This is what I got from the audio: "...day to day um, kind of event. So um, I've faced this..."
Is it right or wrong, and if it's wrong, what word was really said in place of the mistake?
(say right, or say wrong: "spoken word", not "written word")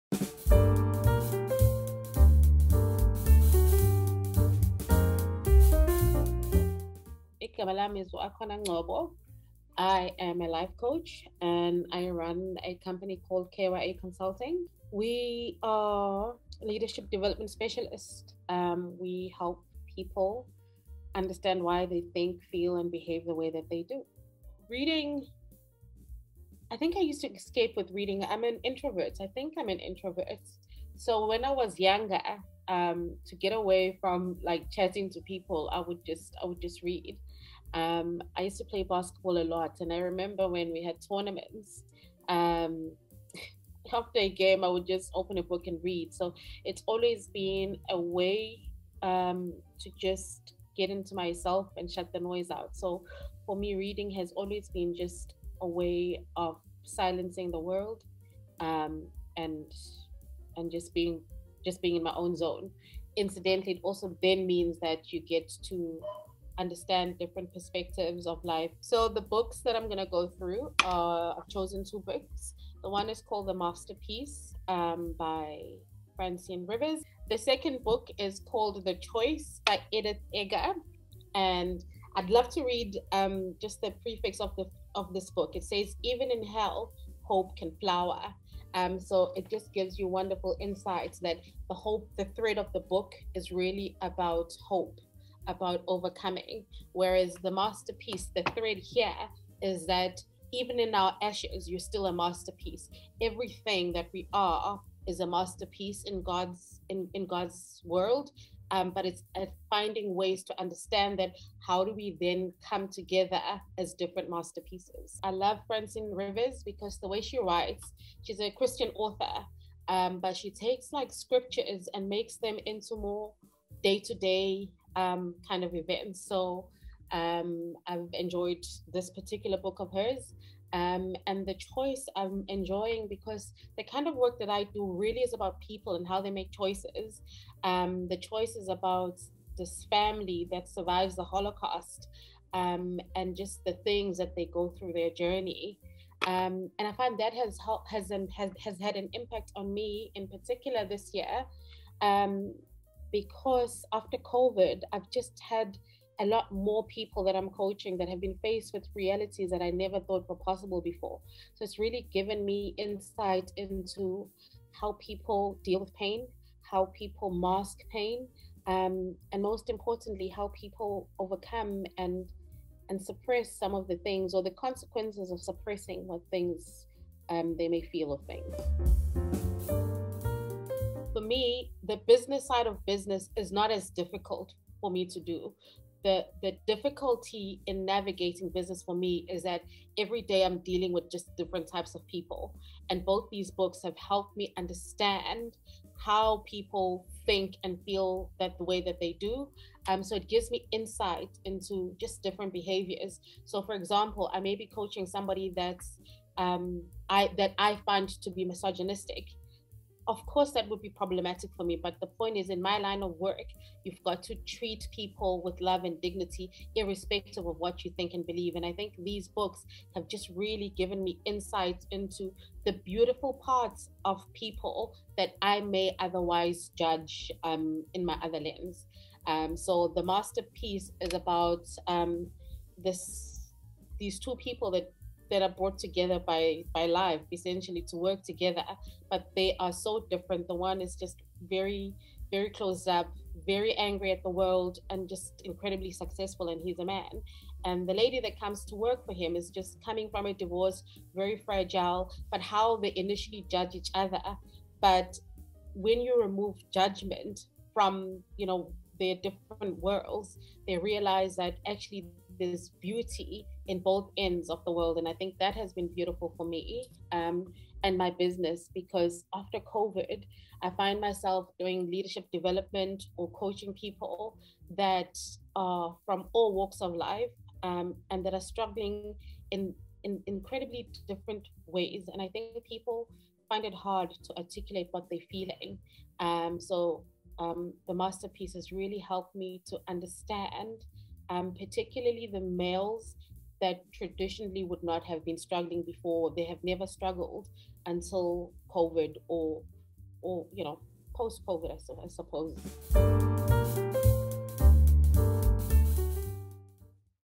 wrong: "enjoyed", not "faced".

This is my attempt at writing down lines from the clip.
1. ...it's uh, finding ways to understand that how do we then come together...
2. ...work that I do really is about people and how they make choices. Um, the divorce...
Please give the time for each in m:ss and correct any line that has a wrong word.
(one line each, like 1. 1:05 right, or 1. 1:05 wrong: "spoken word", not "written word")
1. 1:49 right
2. 2:14 wrong: "choice", not "divorce".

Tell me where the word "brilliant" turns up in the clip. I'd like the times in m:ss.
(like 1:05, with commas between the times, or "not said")
not said.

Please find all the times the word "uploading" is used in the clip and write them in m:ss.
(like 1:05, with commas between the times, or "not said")
not said.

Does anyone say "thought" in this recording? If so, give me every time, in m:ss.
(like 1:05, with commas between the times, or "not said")
2:39.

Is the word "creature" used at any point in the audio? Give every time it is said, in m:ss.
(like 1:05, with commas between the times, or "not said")
not said.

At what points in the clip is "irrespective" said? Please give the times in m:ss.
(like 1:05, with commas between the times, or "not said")
3:36.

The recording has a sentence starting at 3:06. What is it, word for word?
The, the difficulty in navigating business for me is that every day I'm dealing with just different types of people.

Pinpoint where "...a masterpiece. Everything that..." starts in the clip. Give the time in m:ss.
1:42.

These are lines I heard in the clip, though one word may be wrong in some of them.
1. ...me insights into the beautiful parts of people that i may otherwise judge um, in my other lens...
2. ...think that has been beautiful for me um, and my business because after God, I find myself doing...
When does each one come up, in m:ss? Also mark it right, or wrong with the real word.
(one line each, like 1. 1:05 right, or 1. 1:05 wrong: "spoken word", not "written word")
1. 3:41 right
2. 4:25 wrong: "COVID", not "God".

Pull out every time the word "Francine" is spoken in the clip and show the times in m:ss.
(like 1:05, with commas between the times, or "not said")
1:16, 1:55.